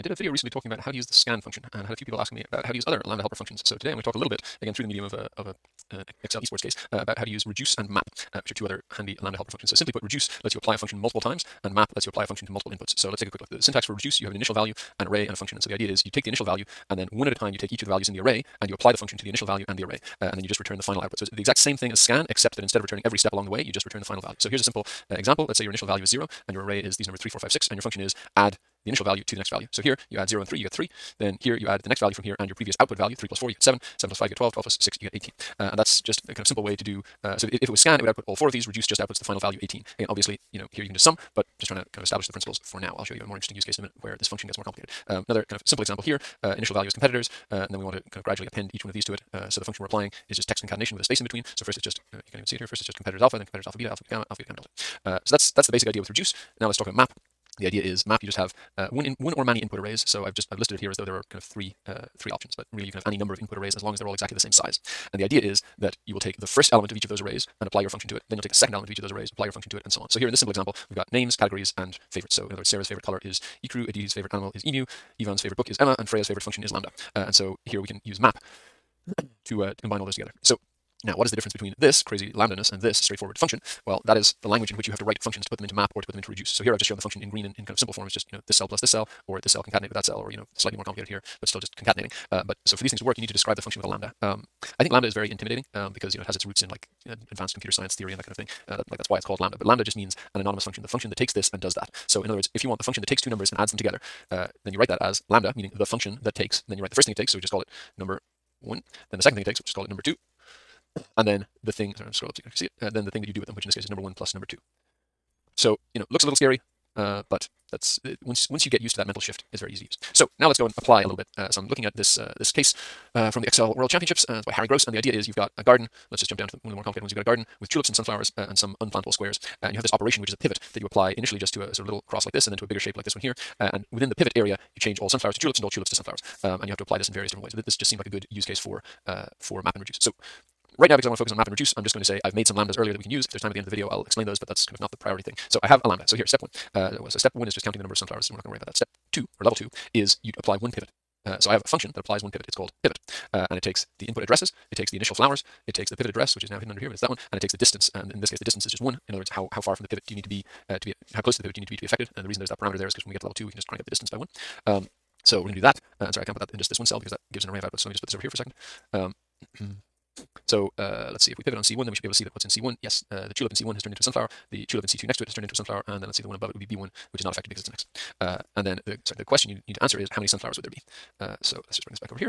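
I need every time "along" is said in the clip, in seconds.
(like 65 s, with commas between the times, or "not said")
23 s.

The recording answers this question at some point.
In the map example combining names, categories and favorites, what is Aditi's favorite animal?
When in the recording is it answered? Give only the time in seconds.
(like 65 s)
74 s.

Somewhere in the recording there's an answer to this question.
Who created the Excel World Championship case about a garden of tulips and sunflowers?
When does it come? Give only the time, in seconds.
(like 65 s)
124 s.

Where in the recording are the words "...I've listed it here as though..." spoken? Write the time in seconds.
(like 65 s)
60 s.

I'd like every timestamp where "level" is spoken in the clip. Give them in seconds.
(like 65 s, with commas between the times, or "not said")
149 s, 163 s.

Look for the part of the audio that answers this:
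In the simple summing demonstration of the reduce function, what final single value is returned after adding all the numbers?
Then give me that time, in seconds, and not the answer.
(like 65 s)
38 s.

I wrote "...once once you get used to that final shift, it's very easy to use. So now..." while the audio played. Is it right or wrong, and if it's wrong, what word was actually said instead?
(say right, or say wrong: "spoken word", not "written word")
wrong: "mental", not "final".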